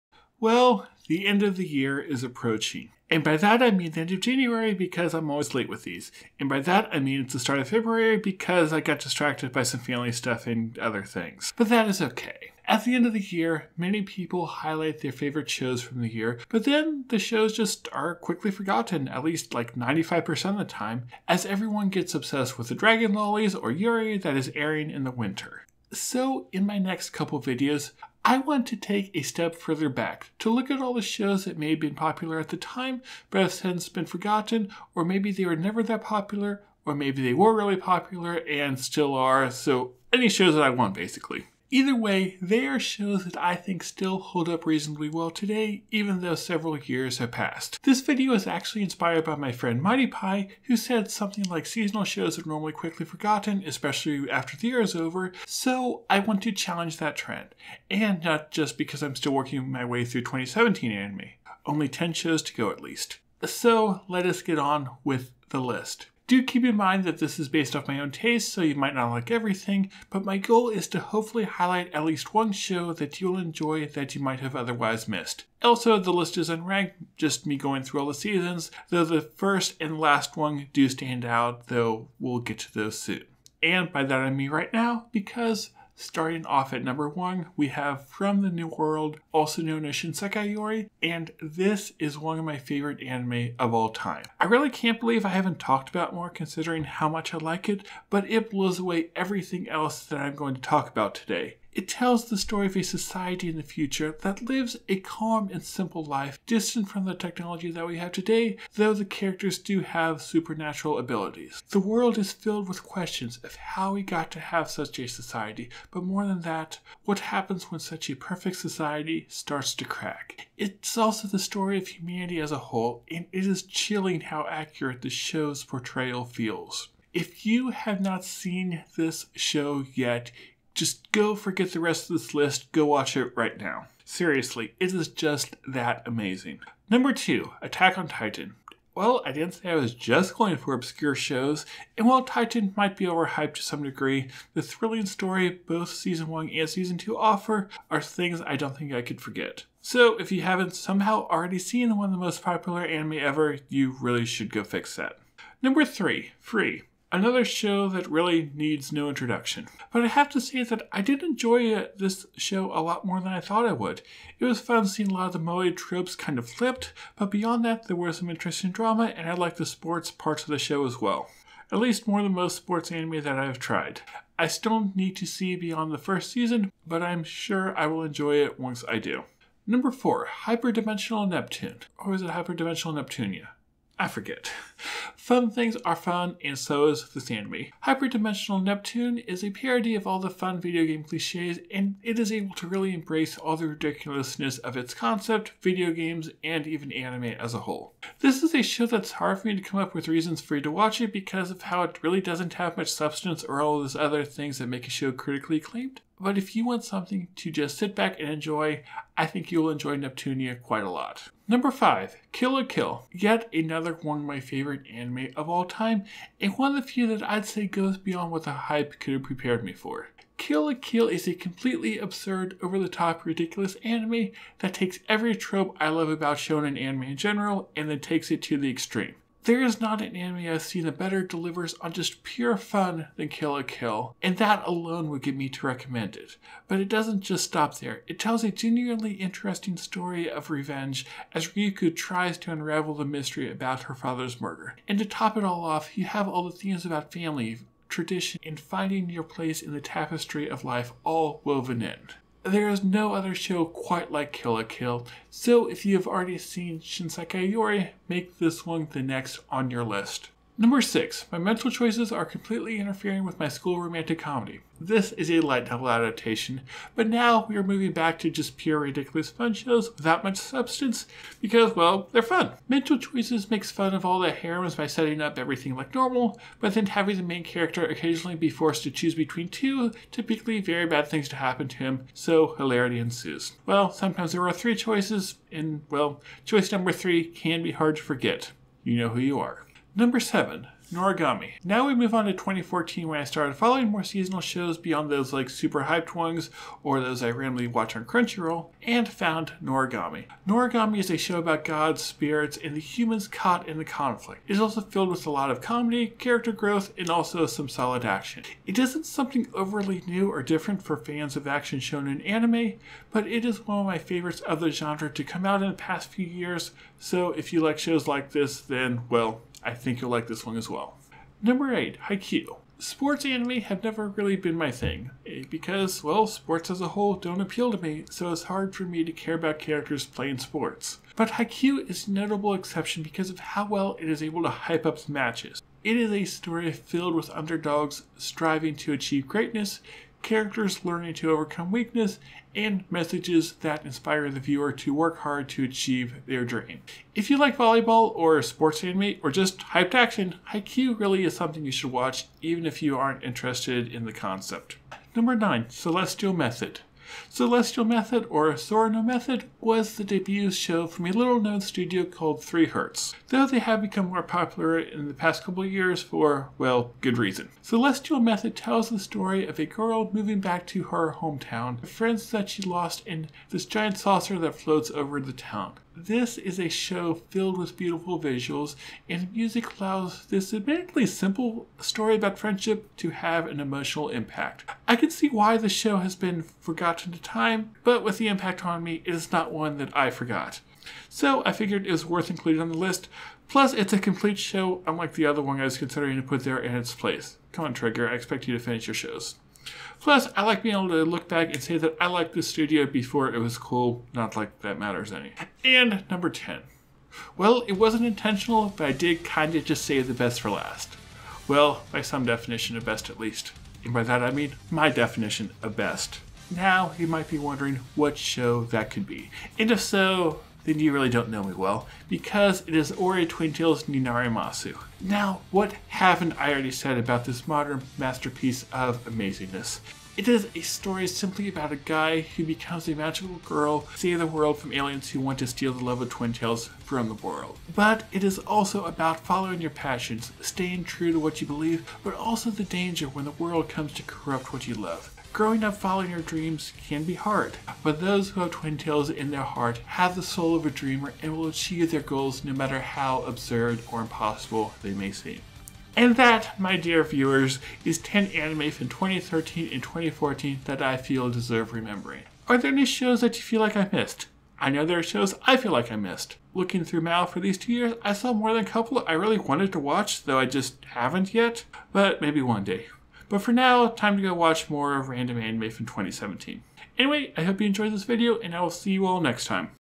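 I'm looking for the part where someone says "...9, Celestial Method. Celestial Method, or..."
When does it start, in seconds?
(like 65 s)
355 s.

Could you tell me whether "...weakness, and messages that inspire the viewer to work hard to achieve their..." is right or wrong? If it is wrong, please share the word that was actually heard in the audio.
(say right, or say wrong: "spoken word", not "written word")
right.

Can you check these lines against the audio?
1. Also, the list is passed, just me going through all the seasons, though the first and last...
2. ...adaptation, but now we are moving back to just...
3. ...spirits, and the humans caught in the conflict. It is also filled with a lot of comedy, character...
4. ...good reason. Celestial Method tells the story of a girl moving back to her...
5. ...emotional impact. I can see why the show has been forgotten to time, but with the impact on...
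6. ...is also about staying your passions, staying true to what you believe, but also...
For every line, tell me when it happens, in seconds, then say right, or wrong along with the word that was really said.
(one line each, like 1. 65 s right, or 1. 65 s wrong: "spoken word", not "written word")
1. 75 s wrong: "unranked", not "passed"
2. 265 s right
3. 302 s right
4. 367 s right
5. 383 s right
6. 438 s wrong: "following", not "staying".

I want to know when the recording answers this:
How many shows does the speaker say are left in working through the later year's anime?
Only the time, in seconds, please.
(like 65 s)
61 s.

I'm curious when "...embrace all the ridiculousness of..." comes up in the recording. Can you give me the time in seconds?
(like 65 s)
192 s.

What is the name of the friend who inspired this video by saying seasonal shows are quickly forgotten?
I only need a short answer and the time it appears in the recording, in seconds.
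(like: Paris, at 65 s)
Mighty Pie, at 49 s.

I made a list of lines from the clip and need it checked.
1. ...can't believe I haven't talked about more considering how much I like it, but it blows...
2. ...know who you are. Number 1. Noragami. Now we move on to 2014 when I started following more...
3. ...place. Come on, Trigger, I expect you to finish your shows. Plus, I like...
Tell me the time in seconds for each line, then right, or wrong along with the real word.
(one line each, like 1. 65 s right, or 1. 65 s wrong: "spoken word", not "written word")
1. 94 s right
2. 288 s wrong: "7", not "1"
3. 396 s right.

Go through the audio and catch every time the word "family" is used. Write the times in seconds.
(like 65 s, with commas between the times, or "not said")
9 s, 247 s.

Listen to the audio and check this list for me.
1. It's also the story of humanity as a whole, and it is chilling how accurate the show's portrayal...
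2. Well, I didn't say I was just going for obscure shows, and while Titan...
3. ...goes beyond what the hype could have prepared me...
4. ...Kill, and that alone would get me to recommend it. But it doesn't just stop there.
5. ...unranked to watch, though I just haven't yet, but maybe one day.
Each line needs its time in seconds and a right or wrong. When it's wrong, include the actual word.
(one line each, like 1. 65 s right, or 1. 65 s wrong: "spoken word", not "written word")
1. 120 s right
2. 138 s right
3. 217 s right
4. 233 s right
5. 469 s wrong: "wanted", not "unranked".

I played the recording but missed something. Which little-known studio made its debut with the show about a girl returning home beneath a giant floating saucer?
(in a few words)
3Hz.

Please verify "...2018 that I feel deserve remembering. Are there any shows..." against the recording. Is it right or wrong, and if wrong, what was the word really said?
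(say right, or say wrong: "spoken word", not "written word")
wrong: "2014", not "2018".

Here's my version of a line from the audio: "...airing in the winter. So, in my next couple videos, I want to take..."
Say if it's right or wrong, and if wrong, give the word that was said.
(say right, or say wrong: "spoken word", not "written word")
right.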